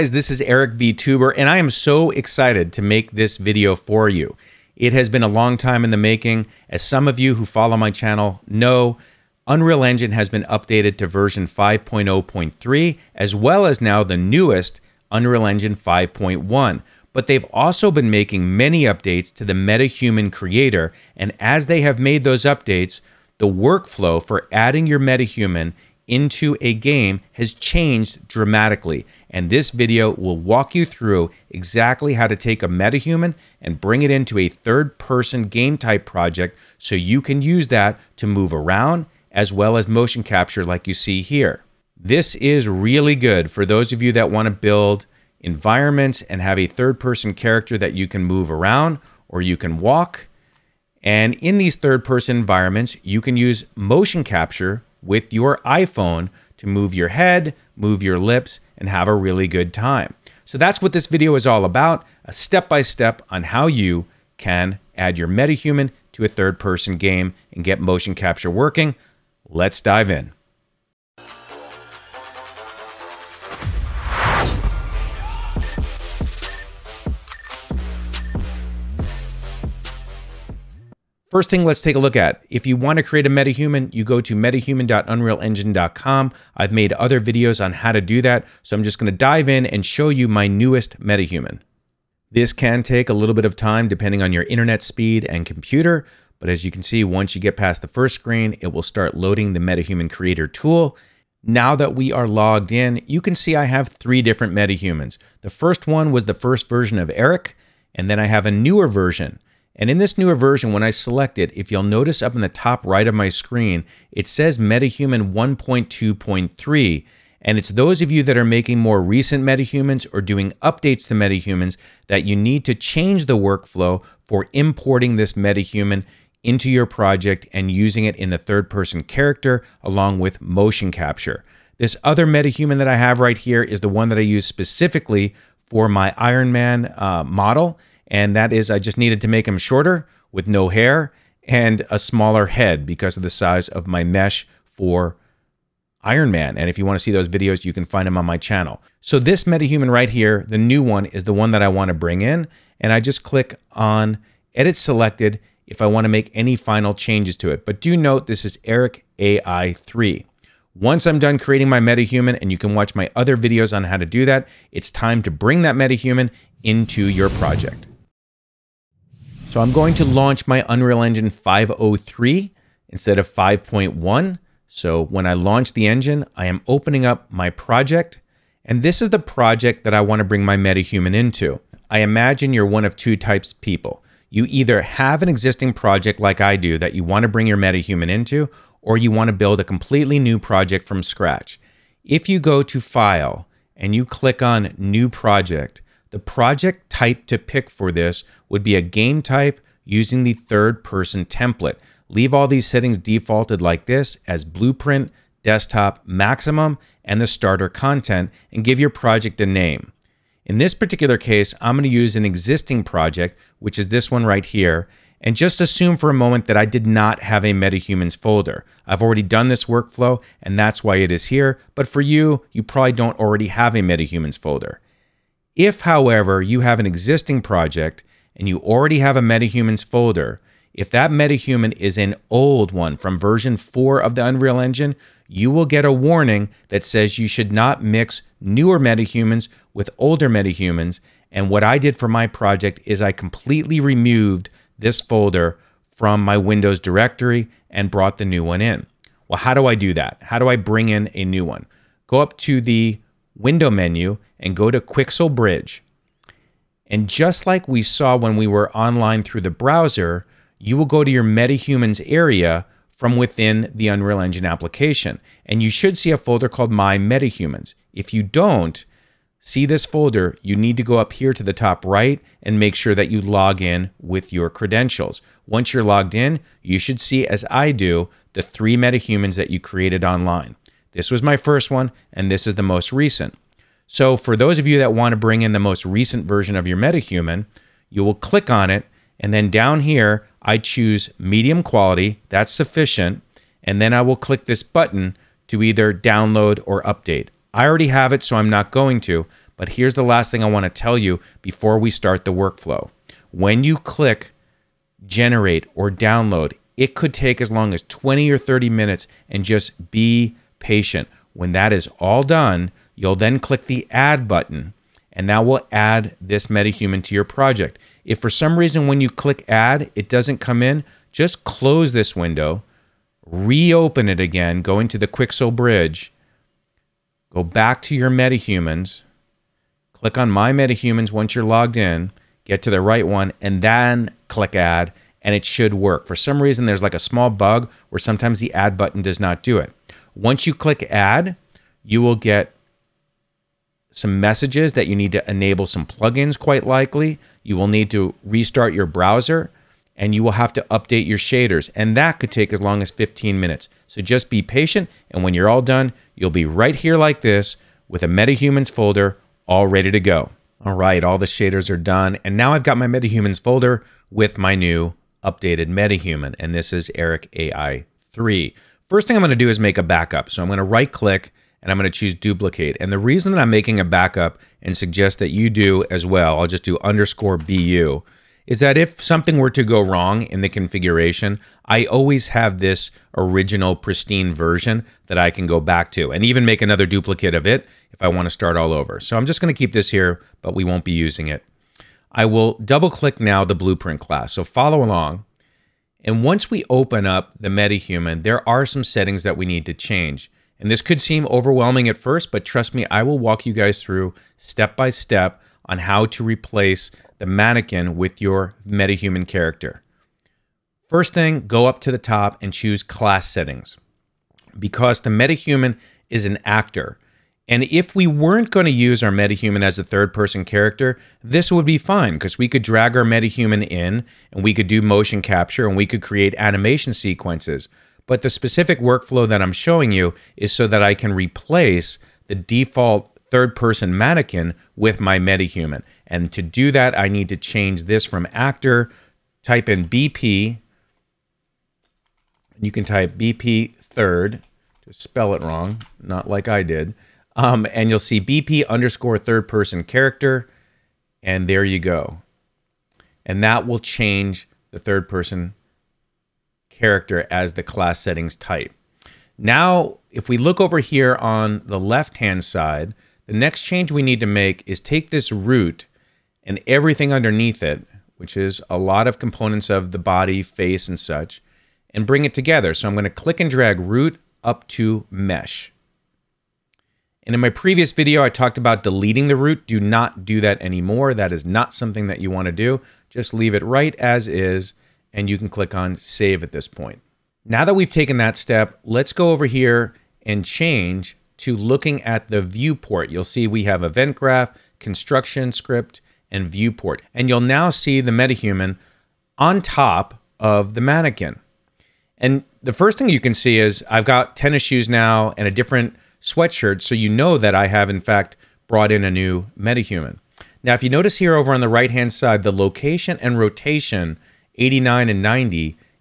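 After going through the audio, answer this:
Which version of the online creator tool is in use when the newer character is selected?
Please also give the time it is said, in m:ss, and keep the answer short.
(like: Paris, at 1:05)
MetaHuman 1.2.3, at 1:54.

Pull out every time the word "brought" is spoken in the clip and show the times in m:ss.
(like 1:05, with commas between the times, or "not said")
4:07, 8:28.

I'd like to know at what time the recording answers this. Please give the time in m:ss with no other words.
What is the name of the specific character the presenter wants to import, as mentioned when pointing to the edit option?
2:38.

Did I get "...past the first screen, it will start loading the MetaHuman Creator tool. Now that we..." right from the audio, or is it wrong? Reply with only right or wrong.
right.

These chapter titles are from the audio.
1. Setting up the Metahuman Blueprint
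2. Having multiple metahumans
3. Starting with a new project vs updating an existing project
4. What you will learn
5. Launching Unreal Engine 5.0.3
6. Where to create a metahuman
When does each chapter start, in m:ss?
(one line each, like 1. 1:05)
1. 5:59
2. 1:40
3. 3:01
4. 0:41
5. 2:49
6. 1:20.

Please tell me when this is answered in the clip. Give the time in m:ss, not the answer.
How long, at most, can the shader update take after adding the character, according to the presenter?
5:52.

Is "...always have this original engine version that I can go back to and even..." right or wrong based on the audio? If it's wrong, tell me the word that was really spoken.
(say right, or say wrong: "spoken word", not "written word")
wrong: "pristine", not "engine".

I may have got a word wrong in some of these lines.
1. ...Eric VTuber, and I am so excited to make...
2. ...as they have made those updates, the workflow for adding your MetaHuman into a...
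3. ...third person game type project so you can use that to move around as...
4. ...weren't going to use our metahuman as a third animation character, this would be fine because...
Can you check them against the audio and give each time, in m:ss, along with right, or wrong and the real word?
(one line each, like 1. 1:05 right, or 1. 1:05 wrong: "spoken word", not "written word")
1. 0:00 right
2. 0:21 right
3. 0:34 right
4. 6:58 wrong: "person", not "animation".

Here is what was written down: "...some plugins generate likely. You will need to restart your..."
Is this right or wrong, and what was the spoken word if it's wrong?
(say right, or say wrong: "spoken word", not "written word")
wrong: "quite", not "generate".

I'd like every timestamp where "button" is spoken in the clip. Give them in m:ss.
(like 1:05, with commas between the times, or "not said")
4:54, 5:14, 5:38.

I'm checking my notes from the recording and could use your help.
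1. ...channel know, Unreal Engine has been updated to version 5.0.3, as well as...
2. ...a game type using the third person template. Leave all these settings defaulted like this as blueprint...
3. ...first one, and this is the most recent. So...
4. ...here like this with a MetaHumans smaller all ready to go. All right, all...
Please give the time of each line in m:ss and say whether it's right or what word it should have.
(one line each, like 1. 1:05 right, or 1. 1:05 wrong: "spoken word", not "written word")
1. 0:07 right
2. 3:18 right
3. 4:41 right
4. 5:56 wrong: "folder", not "smaller".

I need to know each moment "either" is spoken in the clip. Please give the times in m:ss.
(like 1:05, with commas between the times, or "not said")
3:04, 4:55.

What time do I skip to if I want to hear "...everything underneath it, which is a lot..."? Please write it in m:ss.
7:46.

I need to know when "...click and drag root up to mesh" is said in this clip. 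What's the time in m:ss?
7:53.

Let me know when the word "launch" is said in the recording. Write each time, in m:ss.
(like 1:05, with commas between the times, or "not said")
2:50, 2:55.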